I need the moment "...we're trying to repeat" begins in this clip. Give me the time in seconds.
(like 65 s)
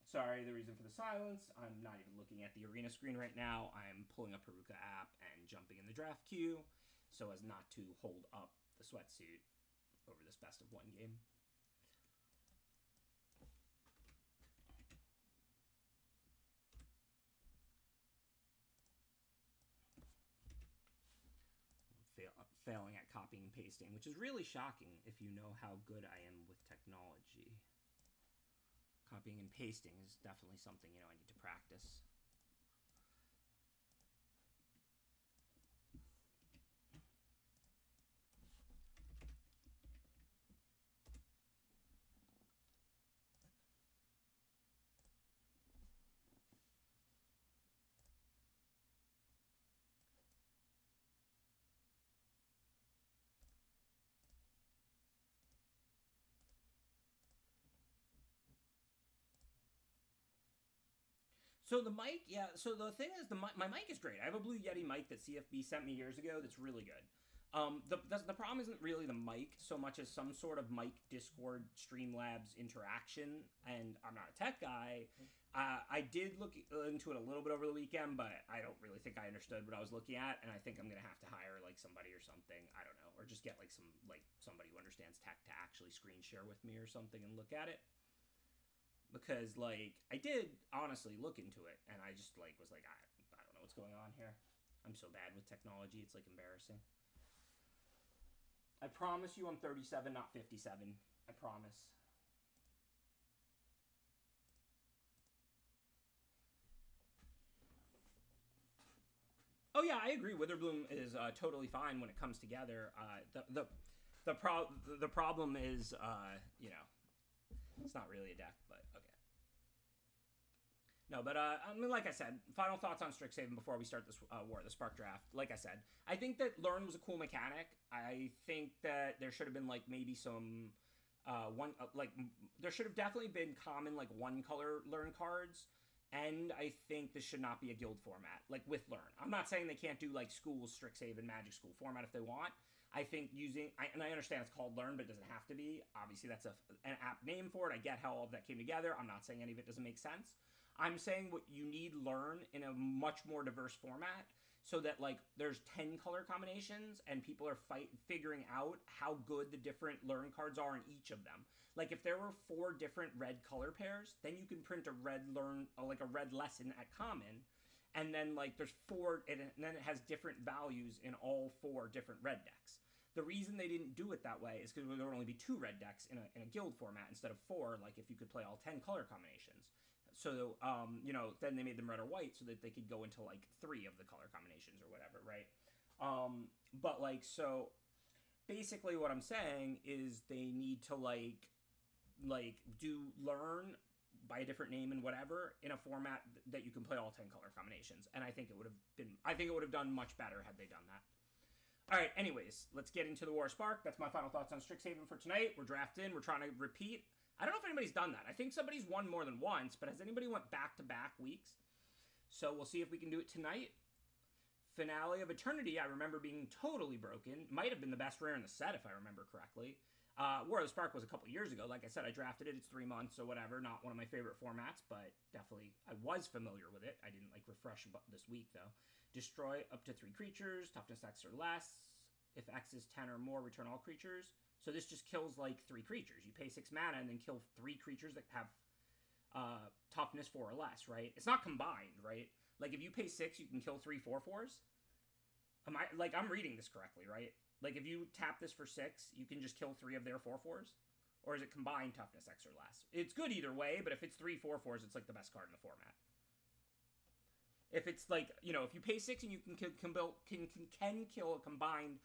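206 s.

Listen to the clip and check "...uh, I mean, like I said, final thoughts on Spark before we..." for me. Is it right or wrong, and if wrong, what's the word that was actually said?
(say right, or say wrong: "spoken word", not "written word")
wrong: "Strixhaven", not "Spark".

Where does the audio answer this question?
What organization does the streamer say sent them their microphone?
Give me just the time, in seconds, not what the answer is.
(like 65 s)
65 s.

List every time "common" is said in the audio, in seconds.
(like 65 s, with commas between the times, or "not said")
133 s, 166 s.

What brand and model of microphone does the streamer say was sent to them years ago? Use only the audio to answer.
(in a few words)
Blue Yeti.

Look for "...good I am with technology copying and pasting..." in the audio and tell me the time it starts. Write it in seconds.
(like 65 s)
25 s.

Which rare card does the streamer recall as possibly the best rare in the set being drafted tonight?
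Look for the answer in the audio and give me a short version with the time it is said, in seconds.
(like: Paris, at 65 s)
Finale of Eternity, at 214 s.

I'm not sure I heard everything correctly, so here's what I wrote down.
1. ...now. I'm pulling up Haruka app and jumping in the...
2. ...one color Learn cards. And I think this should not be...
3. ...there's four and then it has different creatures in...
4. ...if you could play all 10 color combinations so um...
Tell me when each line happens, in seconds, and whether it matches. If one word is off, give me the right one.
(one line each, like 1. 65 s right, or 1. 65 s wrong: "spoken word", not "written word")
1. 3 s right
2. 134 s right
3. 168 s wrong: "values", not "creatures"
4. 177 s right.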